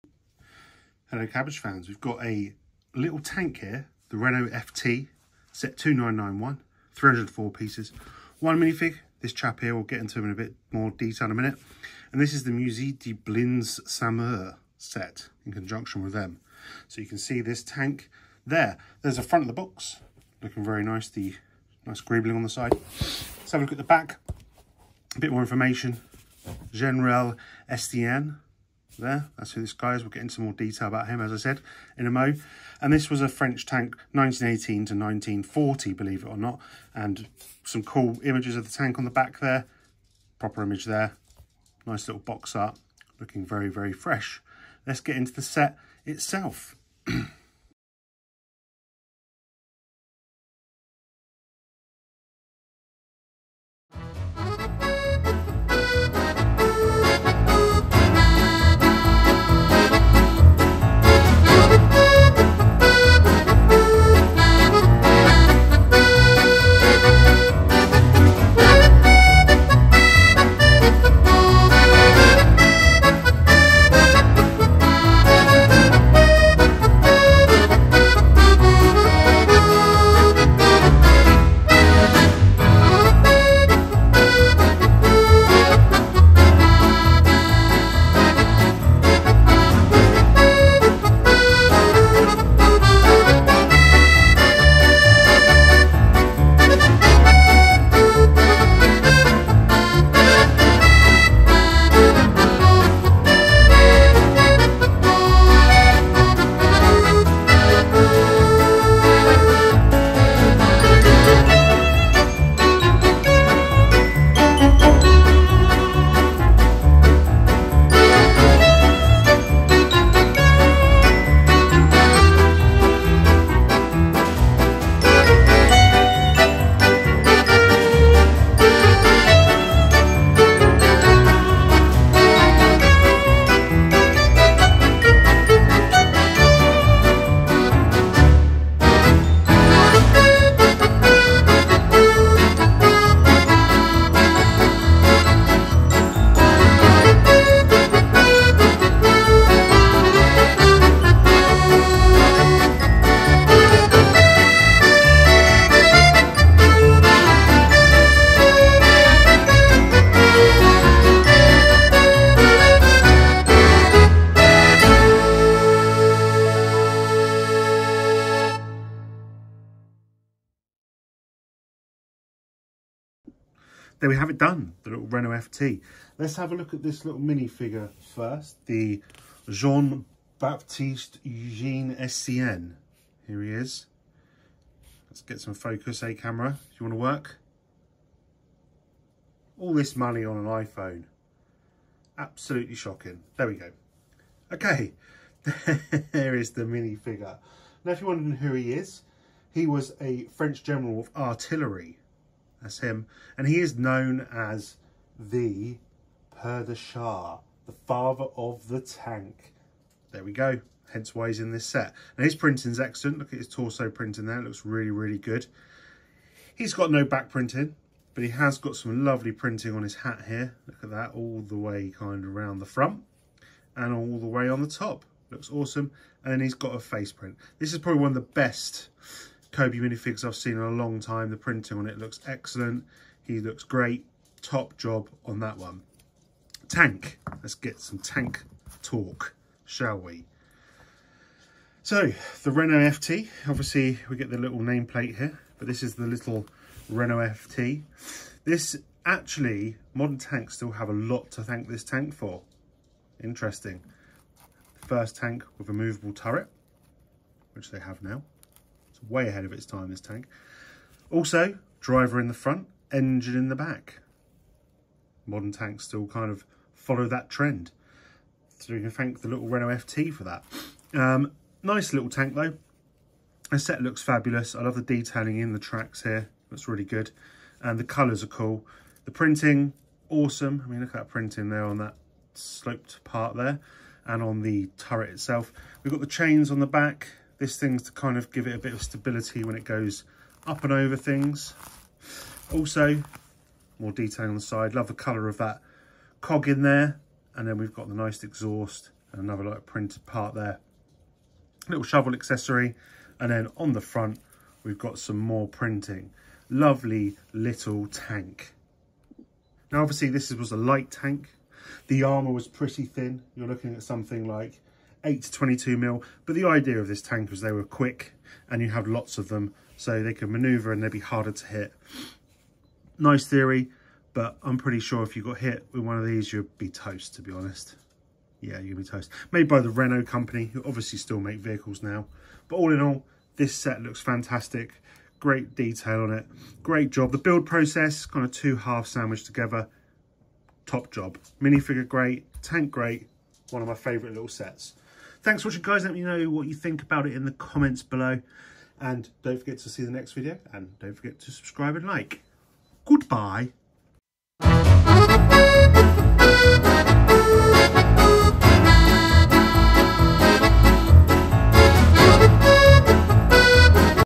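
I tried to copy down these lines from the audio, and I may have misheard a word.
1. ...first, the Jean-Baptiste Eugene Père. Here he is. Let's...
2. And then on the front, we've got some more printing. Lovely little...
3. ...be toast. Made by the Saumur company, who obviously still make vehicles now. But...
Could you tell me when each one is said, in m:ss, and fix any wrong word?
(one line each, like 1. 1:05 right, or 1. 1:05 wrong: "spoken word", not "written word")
1. 2:58 wrong: "Estienne", not "Père"
2. 5:03 right
3. 5:28 wrong: "Renault", not "Saumur".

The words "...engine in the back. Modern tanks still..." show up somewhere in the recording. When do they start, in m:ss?
4:22.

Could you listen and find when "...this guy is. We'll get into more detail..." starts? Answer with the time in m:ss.
0:29.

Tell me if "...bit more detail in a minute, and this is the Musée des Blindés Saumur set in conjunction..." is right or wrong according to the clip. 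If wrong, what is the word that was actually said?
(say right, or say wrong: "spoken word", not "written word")
right.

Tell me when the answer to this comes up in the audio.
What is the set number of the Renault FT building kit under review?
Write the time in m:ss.
0:05.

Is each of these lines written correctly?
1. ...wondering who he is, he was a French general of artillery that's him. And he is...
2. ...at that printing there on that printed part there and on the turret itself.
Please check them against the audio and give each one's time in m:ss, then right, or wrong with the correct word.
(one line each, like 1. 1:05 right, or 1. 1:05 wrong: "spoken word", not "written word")
1. 3:18 right
2. 4:40 wrong: "sloped", not "printed".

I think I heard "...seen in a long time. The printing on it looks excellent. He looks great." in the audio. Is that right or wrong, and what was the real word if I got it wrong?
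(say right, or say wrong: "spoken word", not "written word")
right.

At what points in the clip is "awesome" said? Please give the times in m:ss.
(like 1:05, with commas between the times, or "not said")
3:45, 4:40.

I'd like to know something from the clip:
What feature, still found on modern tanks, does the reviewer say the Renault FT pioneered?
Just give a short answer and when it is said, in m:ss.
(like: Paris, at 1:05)
movable turret, at 4:15.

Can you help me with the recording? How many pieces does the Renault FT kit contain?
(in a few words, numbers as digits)
304.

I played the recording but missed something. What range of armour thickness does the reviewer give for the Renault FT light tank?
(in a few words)
8 to 22 mm.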